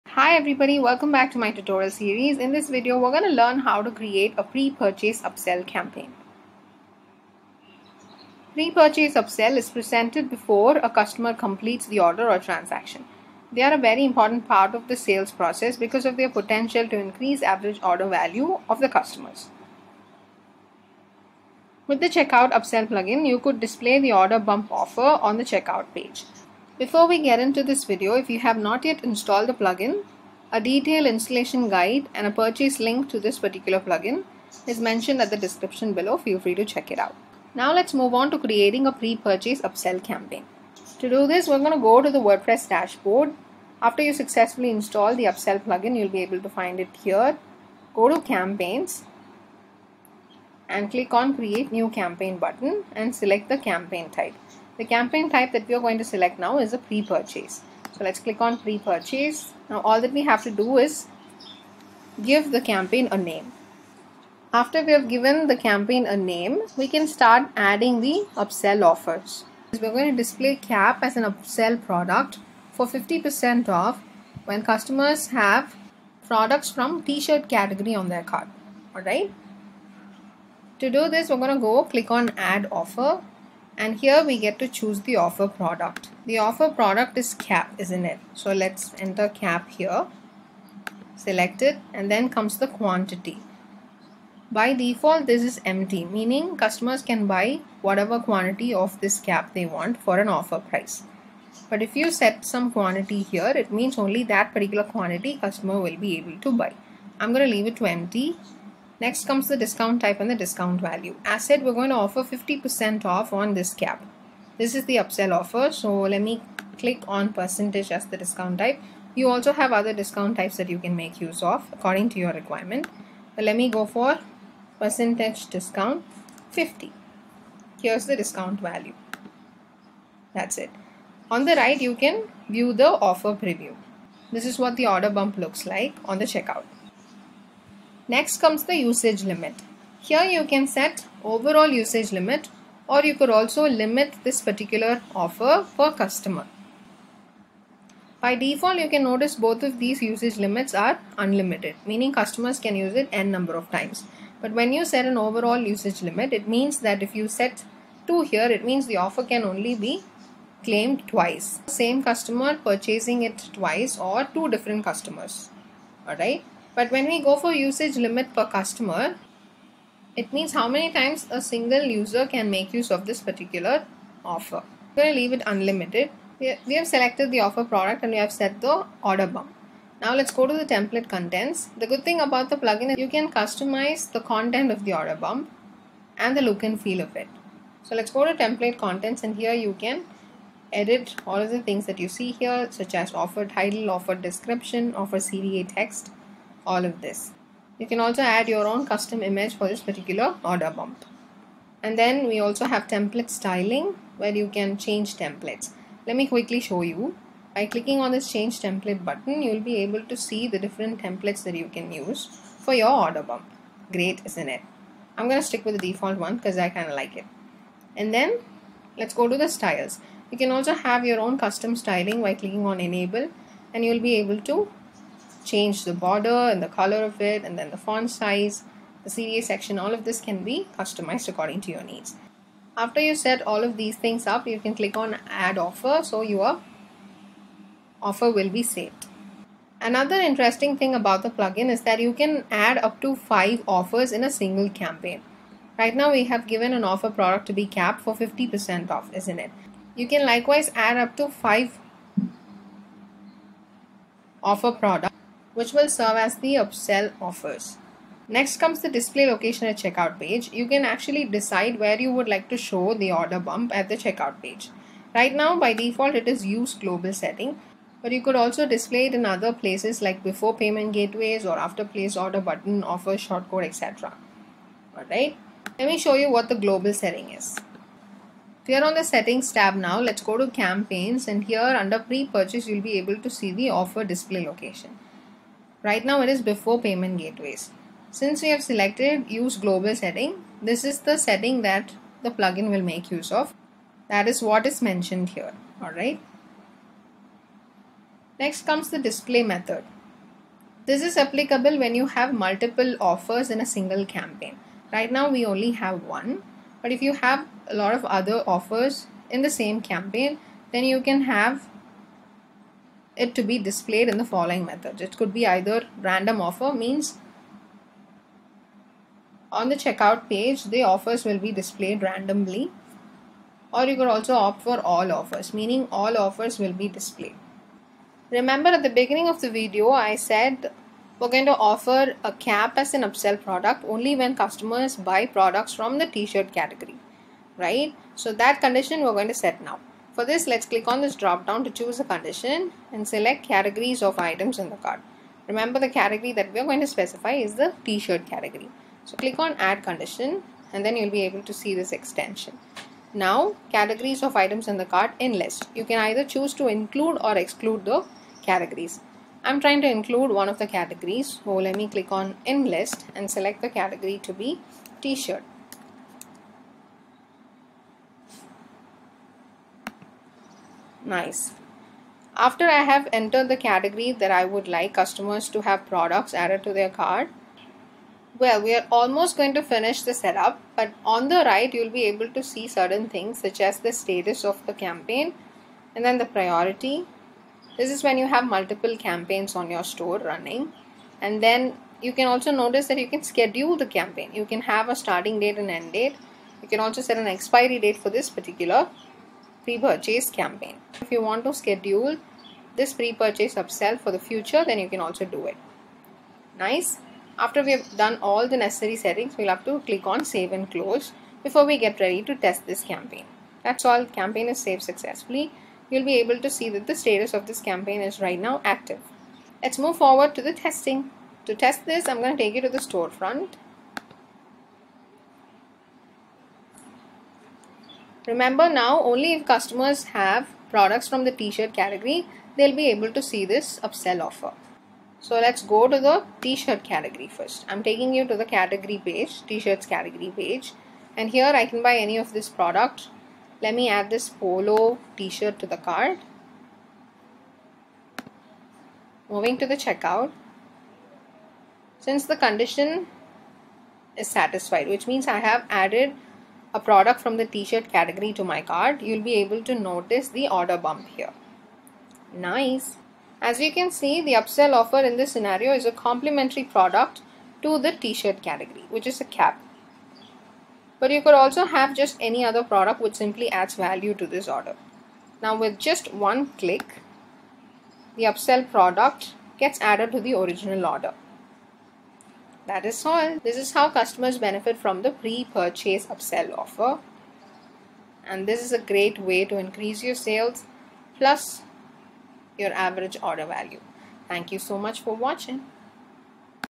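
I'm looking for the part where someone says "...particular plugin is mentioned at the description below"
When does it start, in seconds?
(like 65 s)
33 s.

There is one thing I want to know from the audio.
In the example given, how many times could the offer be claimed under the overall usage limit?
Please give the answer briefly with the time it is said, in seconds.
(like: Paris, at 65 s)
2, at 158 s.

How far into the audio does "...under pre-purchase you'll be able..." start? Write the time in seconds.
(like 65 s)
281 s.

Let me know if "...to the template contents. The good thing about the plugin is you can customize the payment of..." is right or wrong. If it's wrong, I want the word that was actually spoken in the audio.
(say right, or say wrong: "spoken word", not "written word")
wrong: "content", not "payment".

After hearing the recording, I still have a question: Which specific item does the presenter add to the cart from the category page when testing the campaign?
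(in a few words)
polo t-shirt.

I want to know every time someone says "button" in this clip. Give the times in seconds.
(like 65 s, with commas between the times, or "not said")
52 s, 209 s, 272 s.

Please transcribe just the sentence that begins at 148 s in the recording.
By default, you can notice both of these usage limits are unlimited, meaning customers can use it n number of times.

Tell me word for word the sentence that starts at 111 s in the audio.
As said, we're going to offer 50% off on this cap.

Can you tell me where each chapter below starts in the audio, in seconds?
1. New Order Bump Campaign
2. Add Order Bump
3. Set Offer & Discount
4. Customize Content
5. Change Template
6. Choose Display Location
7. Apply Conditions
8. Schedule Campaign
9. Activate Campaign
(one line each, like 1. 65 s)
1. 40 s
2. 69 s
3. 86 s
4. 180 s
5. 202 s
6. 259 s
7. 328 s
8. 390 s
9. 410 s.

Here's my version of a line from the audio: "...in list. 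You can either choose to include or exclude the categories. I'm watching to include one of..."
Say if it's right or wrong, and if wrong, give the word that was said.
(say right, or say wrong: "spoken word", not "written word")
wrong: "trying", not "watching".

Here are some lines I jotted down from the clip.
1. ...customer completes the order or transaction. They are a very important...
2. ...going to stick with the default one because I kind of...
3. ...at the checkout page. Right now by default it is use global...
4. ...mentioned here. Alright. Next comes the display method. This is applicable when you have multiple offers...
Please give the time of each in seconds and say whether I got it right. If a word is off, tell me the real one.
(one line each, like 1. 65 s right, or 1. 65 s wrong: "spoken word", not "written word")
1. 10 s right
2. 215 s right
3. 263 s right
4. 294 s right.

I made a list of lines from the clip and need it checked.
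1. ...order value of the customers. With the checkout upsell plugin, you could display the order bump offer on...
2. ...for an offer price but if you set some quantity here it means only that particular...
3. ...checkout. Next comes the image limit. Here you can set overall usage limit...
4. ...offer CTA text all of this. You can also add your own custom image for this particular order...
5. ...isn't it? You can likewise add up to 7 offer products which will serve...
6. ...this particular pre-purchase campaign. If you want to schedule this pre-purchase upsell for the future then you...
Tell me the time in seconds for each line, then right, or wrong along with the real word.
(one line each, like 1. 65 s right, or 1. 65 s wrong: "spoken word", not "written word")
1. 17 s right
2. 99 s right
3. 136 s wrong: "usage", not "image"
4. 194 s right
5. 249 s wrong: "5", not "7"
6. 398 s right.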